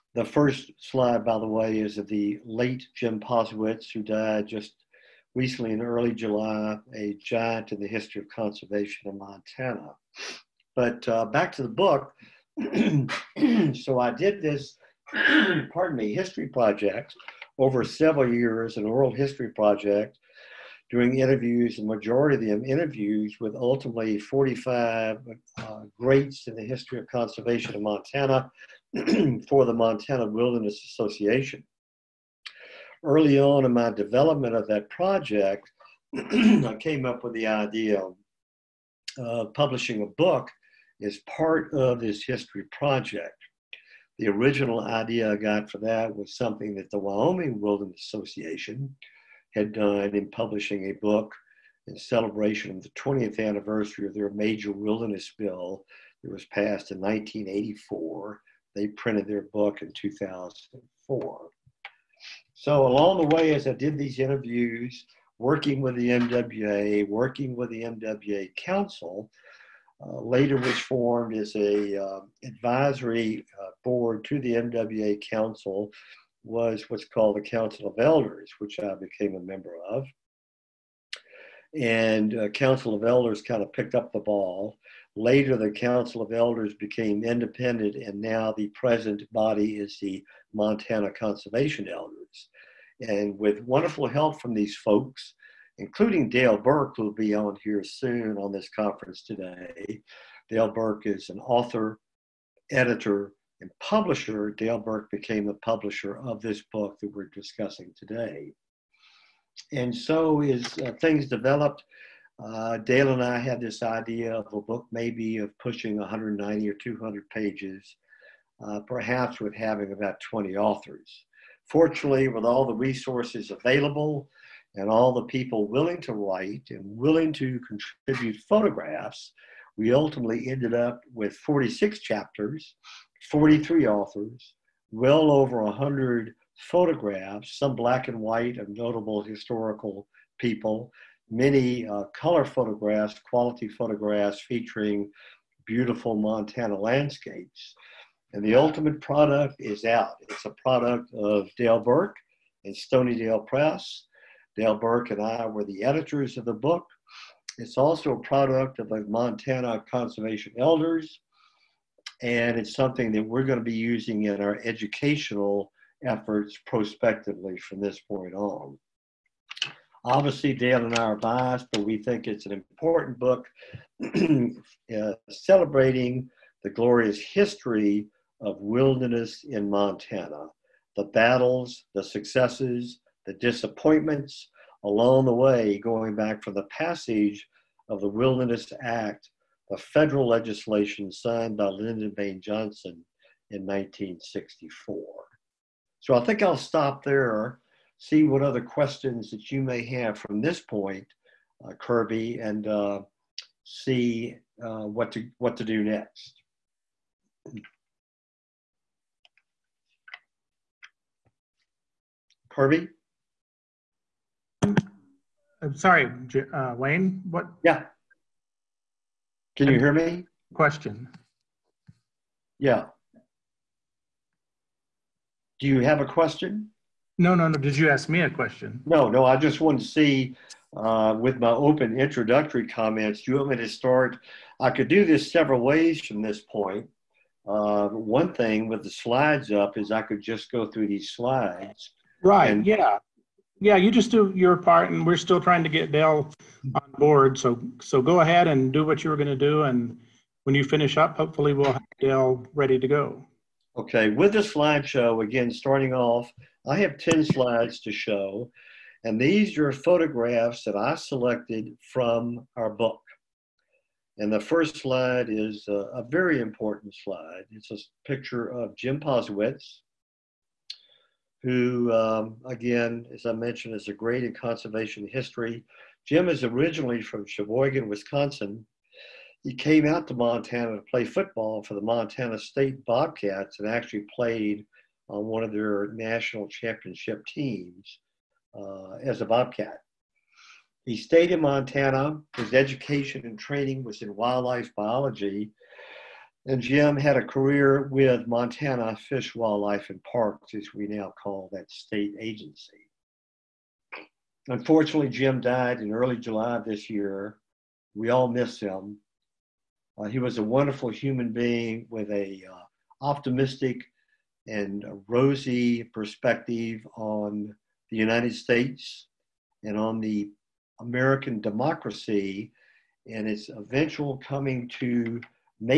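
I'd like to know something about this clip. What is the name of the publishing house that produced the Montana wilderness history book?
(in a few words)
Stoneydale Press.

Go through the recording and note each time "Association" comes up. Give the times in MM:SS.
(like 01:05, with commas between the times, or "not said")
00:30, 00:48.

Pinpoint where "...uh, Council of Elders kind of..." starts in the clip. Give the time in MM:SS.
01:22.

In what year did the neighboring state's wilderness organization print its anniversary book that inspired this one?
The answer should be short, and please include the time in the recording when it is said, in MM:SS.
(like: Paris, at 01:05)
2004, at 00:59.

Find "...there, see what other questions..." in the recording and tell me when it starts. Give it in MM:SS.
03:17.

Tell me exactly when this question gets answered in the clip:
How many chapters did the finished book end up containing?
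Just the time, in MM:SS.
02:11.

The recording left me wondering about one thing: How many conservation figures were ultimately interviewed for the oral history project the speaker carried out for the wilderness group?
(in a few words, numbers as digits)
45.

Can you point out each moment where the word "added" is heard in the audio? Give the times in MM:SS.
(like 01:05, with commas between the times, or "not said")
not said.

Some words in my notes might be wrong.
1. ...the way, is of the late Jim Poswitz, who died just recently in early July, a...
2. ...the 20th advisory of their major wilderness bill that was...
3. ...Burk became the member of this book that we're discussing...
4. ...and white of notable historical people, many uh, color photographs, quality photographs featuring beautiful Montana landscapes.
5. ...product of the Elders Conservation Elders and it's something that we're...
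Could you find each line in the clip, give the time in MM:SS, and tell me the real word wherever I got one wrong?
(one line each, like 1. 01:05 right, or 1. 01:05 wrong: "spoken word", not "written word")
1. 00:01 right
2. 00:52 wrong: "anniversary", not "advisory"
3. 01:44 wrong: "publisher", not "member"
4. 02:18 right
5. 02:38 wrong: "Montana", not "Elders".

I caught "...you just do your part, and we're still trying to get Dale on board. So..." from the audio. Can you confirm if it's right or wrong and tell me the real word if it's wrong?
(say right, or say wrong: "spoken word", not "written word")
right.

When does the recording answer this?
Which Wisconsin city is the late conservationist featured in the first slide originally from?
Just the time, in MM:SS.
04:37.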